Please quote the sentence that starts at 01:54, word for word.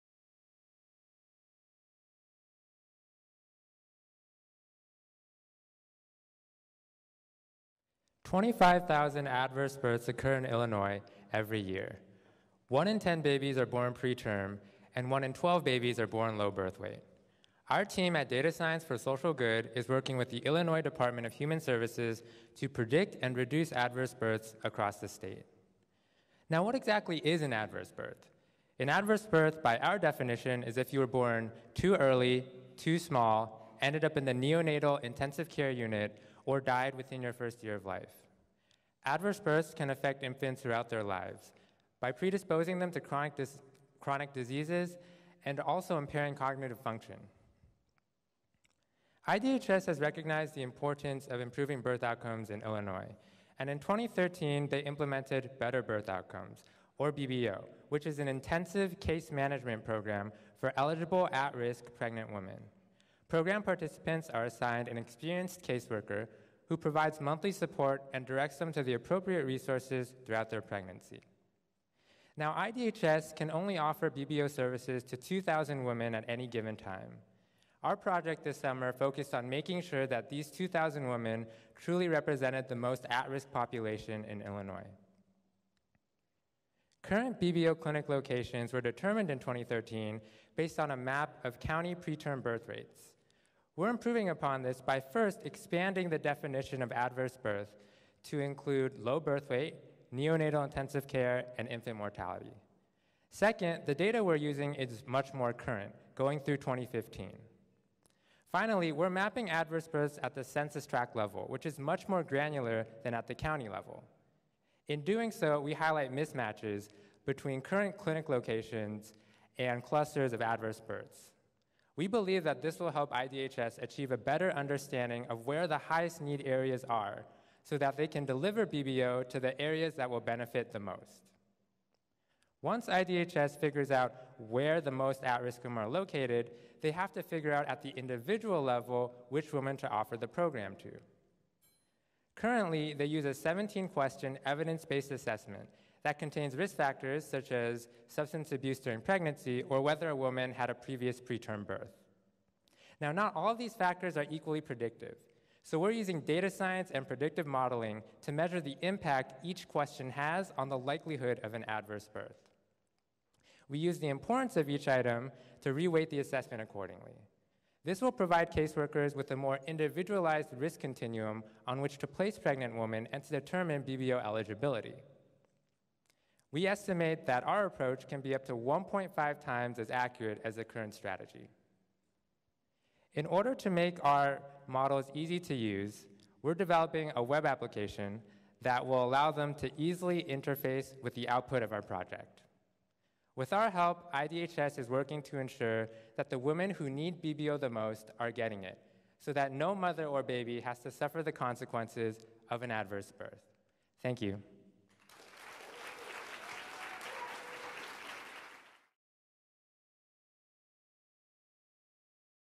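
In doing so, we highlight mismatches between current clinic locations and clusters of adverse births.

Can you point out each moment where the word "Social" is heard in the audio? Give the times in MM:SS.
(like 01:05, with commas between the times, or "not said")
00:18.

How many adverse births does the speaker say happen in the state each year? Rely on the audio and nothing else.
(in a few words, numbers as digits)
25,000.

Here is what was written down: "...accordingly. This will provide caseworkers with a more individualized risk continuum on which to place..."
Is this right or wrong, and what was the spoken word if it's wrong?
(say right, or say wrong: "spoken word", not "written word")
right.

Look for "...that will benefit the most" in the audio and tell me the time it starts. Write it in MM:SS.
02:09.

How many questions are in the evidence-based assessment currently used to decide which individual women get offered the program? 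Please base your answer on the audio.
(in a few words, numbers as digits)
17.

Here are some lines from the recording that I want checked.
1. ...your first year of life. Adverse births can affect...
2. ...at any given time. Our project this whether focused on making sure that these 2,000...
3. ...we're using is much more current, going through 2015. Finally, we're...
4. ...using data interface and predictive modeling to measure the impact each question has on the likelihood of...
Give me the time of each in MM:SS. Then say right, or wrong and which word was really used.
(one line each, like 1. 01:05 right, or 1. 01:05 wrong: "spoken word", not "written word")
1. 00:37 right
2. 01:16 wrong: "summer", not "whether"
3. 01:44 right
4. 02:35 wrong: "science", not "interface".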